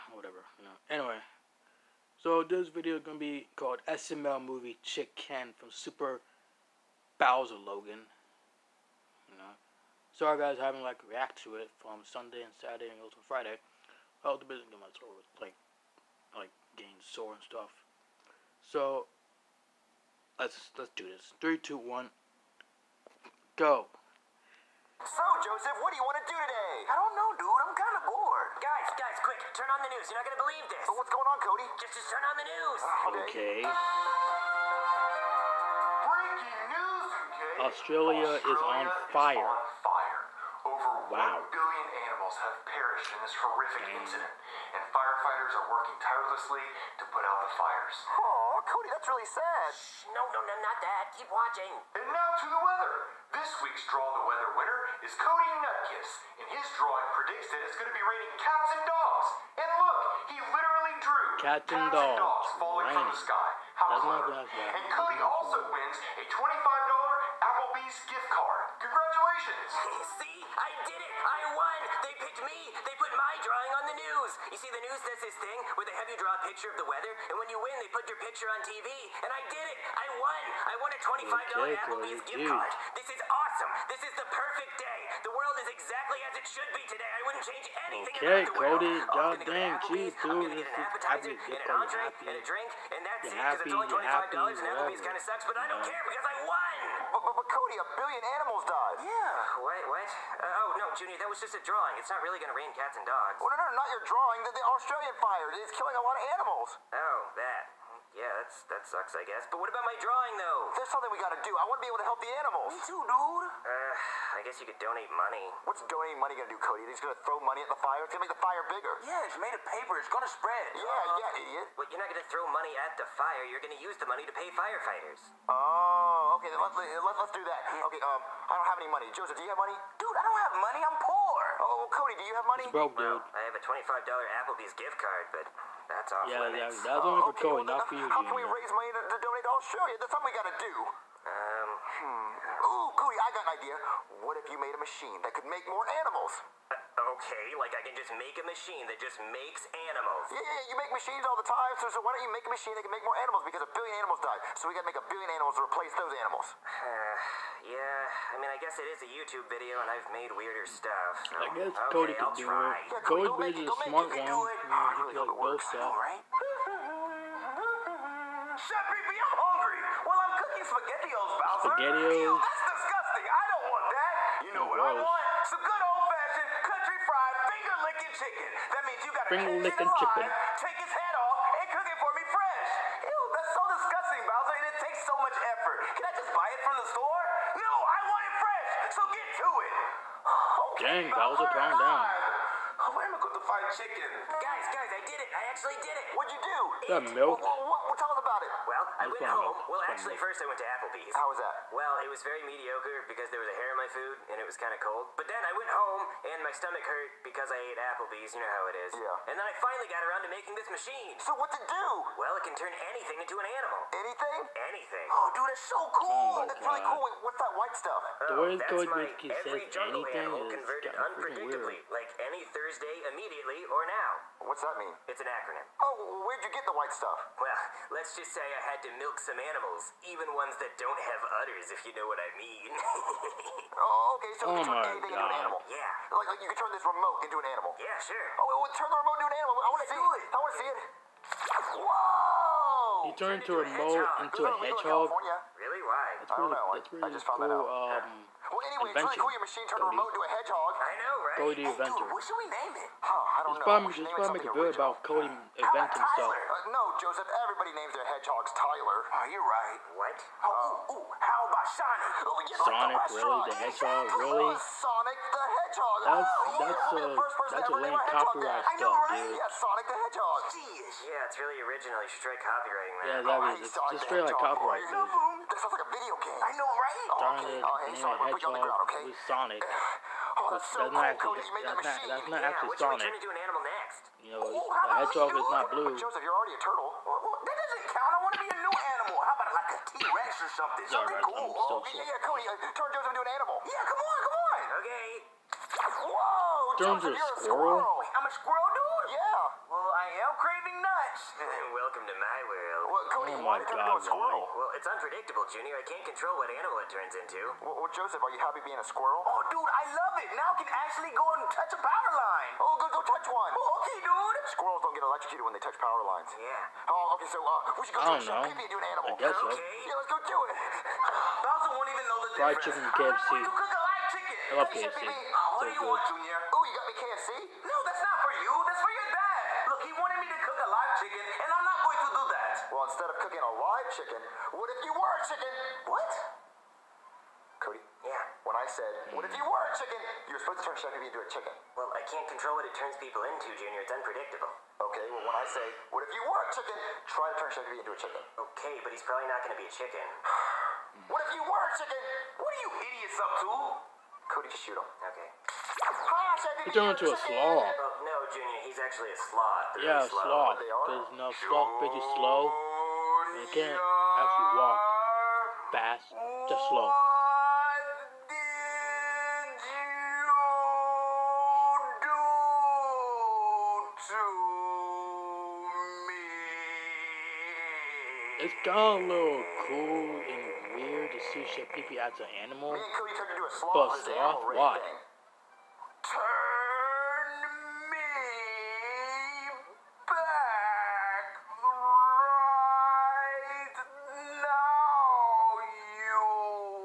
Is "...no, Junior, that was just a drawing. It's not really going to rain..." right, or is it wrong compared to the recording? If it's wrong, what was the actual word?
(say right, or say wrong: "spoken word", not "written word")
right.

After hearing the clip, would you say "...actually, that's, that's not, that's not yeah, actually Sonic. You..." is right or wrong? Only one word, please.
right.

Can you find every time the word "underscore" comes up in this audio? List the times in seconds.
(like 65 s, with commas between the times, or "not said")
not said.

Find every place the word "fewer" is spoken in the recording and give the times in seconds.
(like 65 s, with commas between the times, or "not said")
not said.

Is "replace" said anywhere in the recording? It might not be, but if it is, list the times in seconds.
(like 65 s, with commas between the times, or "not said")
155 s.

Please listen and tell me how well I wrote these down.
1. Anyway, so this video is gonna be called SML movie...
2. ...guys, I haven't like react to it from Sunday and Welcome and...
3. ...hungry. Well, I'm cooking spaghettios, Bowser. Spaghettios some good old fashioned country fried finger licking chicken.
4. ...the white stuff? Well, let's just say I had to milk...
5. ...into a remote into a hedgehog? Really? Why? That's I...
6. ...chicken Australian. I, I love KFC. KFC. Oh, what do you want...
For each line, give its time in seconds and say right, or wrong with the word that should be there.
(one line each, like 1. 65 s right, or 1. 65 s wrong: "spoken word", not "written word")
1. 0 s right
2. 10 s wrong: "Saturday", not "Welcome"
3. 169 s right
4. 226 s right
5. 243 s right
6. 322 s wrong: "KFC", not "Australian".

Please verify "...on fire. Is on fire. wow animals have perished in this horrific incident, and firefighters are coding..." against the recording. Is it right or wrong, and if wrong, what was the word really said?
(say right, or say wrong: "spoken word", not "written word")
wrong: "working", not "coding".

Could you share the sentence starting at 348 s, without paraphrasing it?
Okay, but he's probably not going to be a chicken.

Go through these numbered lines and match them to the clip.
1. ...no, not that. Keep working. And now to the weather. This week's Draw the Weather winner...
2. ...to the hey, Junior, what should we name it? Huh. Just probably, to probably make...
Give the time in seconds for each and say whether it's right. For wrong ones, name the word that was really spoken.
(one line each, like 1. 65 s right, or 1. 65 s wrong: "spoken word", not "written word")
1. 50 s wrong: "watching", not "working"
2. 251 s wrong: "Dude", not "Junior".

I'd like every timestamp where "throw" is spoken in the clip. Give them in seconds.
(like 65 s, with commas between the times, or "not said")
117 s, 122 s.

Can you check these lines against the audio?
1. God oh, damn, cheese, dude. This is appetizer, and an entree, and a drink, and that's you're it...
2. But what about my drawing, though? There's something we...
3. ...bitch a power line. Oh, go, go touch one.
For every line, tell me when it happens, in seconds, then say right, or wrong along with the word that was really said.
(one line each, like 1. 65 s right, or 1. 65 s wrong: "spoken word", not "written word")
1. 89 s right
2. 109 s right
3. 311 s wrong: "touch", not "bitch".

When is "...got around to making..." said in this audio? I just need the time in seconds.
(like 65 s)
209 s.